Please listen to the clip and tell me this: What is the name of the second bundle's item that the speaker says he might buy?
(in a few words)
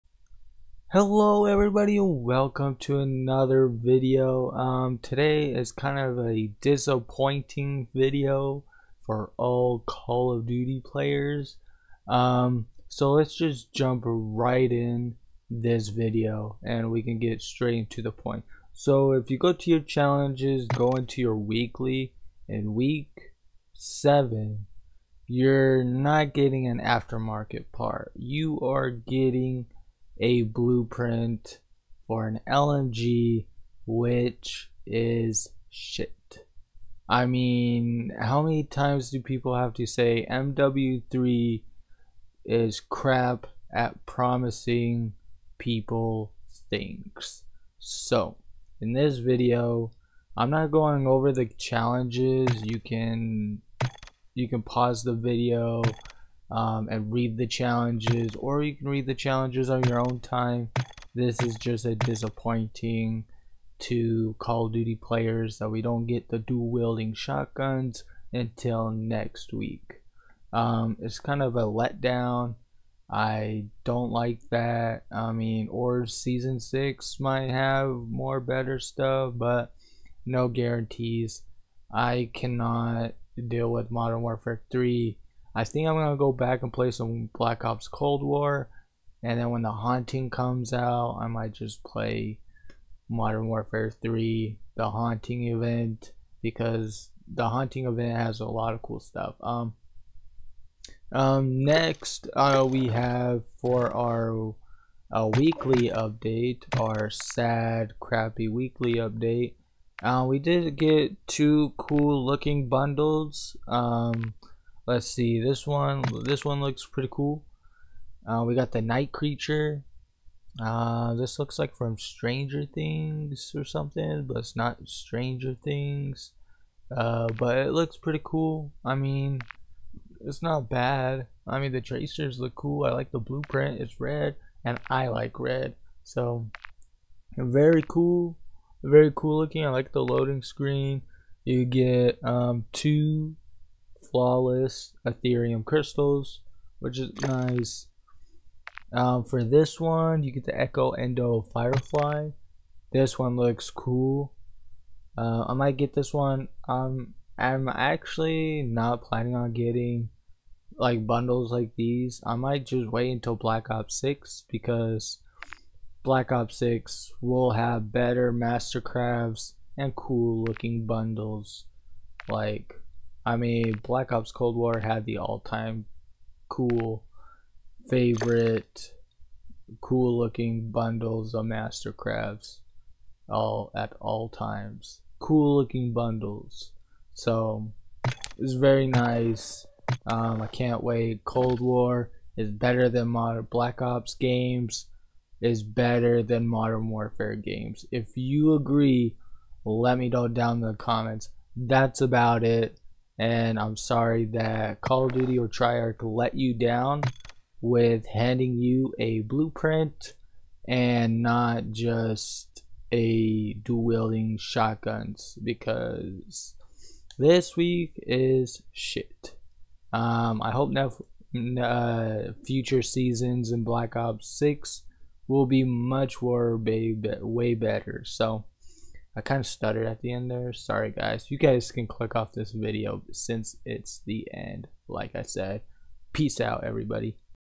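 Echo Endo Firefly.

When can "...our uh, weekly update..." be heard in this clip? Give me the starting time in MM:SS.
01:43.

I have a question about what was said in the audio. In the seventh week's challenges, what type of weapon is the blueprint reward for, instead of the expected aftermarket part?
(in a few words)
LMG.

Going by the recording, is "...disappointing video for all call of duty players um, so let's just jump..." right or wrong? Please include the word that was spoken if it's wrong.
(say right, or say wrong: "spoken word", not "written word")
right.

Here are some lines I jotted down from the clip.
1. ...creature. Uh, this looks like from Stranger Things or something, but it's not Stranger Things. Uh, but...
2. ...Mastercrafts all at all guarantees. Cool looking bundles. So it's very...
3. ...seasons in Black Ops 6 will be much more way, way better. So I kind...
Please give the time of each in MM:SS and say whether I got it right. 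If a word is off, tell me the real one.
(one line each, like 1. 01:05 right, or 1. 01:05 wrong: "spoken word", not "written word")
1. 01:59 right
2. 03:01 wrong: "times", not "guarantees"
3. 03:42 right.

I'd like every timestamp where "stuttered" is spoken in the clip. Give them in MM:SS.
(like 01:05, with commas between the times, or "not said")
03:49.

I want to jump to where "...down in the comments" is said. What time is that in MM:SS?
03:20.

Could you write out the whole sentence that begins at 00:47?
So, in this video, I'm not going over the challenges.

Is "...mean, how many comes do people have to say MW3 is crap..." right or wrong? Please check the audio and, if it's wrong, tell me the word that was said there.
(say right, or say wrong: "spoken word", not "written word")
wrong: "times", not "comes".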